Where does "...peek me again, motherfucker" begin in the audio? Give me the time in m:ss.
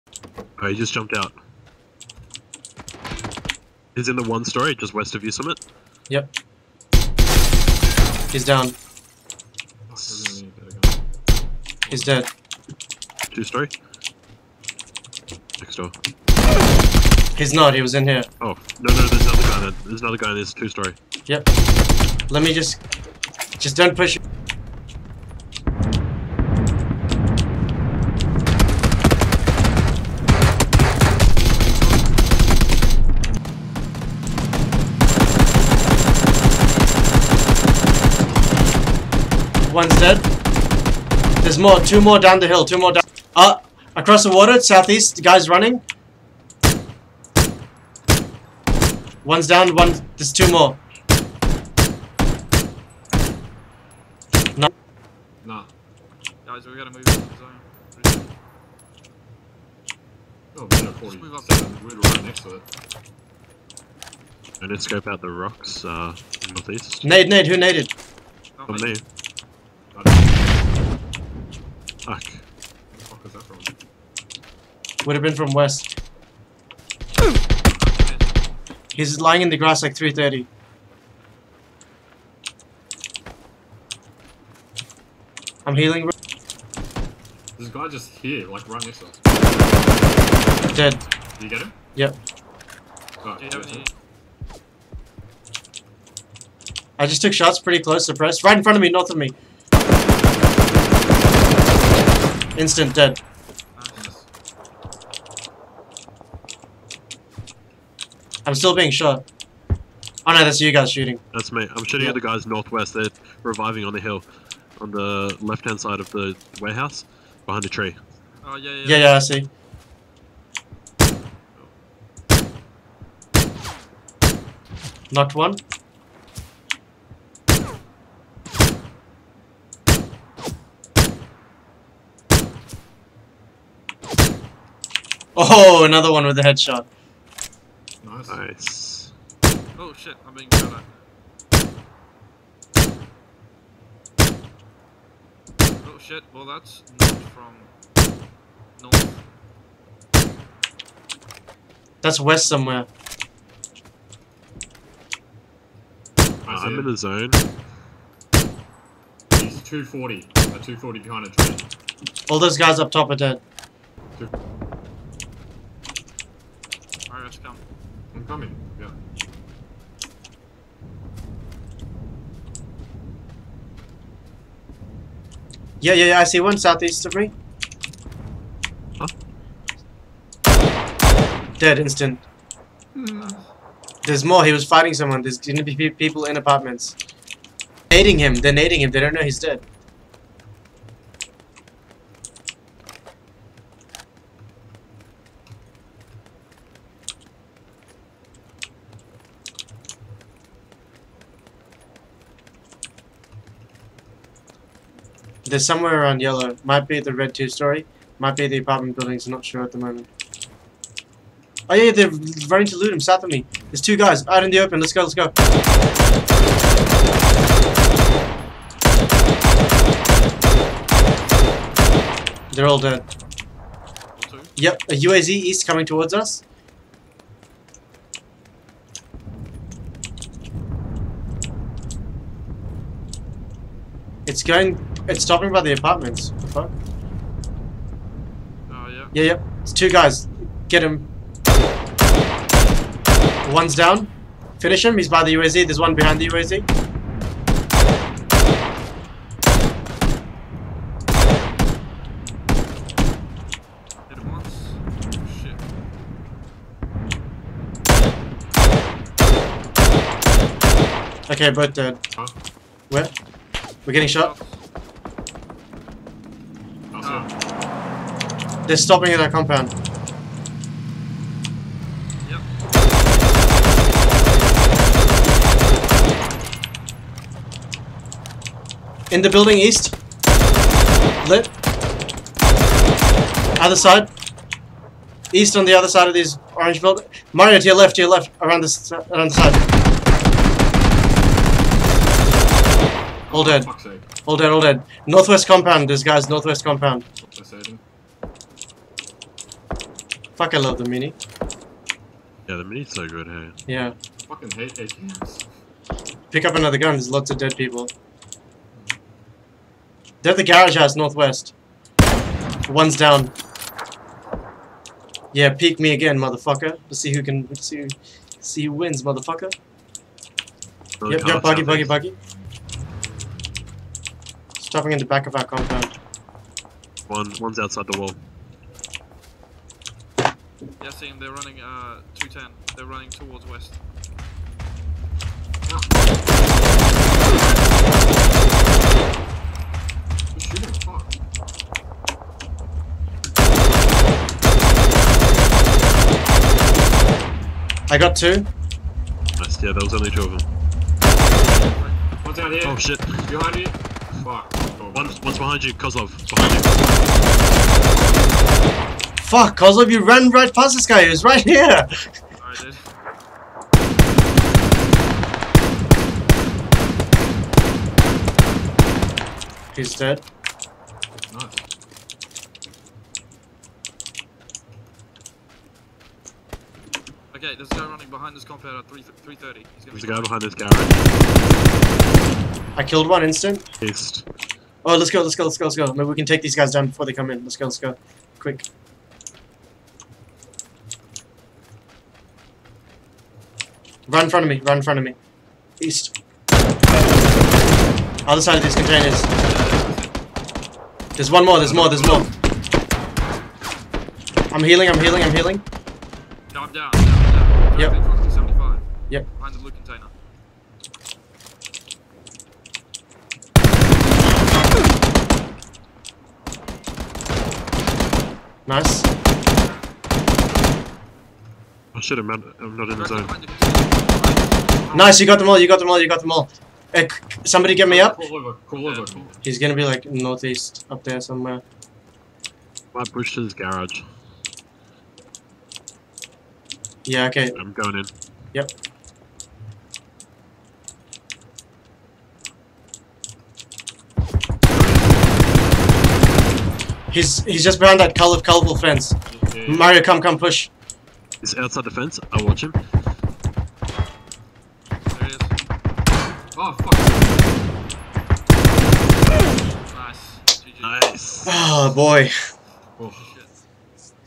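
5:15.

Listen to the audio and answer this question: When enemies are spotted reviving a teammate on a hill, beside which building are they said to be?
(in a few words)
the warehouse.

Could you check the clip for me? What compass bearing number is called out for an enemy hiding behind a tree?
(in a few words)
240.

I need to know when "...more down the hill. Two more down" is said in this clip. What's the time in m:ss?
0:42.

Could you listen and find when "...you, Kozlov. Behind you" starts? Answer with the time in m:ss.
5:55.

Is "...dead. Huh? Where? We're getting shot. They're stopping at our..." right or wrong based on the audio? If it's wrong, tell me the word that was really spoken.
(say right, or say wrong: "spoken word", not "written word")
right.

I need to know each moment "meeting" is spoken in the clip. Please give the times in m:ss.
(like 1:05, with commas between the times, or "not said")
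not said.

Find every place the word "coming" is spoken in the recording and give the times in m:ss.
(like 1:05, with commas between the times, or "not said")
2:48, 3:45.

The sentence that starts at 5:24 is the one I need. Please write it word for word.
Stopping in the back of our compound.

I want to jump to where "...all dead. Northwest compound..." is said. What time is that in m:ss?
4:54.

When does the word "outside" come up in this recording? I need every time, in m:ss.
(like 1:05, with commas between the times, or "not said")
5:27, 7:31.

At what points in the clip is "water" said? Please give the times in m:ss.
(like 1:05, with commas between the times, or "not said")
0:44.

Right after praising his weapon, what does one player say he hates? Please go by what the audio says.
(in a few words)
ATMs.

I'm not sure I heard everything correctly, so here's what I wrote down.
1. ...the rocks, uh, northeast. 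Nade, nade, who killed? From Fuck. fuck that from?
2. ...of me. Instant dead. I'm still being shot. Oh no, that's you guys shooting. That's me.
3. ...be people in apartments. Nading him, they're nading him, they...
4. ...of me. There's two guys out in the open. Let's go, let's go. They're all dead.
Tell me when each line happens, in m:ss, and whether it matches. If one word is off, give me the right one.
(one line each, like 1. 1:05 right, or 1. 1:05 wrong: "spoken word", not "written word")
1. 1:05 wrong: "naded", not "killed"
2. 1:39 right
3. 3:05 right
4. 3:33 right.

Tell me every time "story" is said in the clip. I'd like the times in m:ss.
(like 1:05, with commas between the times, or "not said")
0:04, 0:13, 0:20, 3:27.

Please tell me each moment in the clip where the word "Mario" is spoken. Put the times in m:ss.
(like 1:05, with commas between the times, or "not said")
4:47, 7:29.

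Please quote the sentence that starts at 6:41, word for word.
There's one more, there's more, there's more.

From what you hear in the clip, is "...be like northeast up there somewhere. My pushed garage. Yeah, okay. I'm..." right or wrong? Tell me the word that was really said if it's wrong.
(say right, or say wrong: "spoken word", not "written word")
right.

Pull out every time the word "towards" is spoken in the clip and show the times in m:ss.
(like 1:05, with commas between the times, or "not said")
3:45, 5:33.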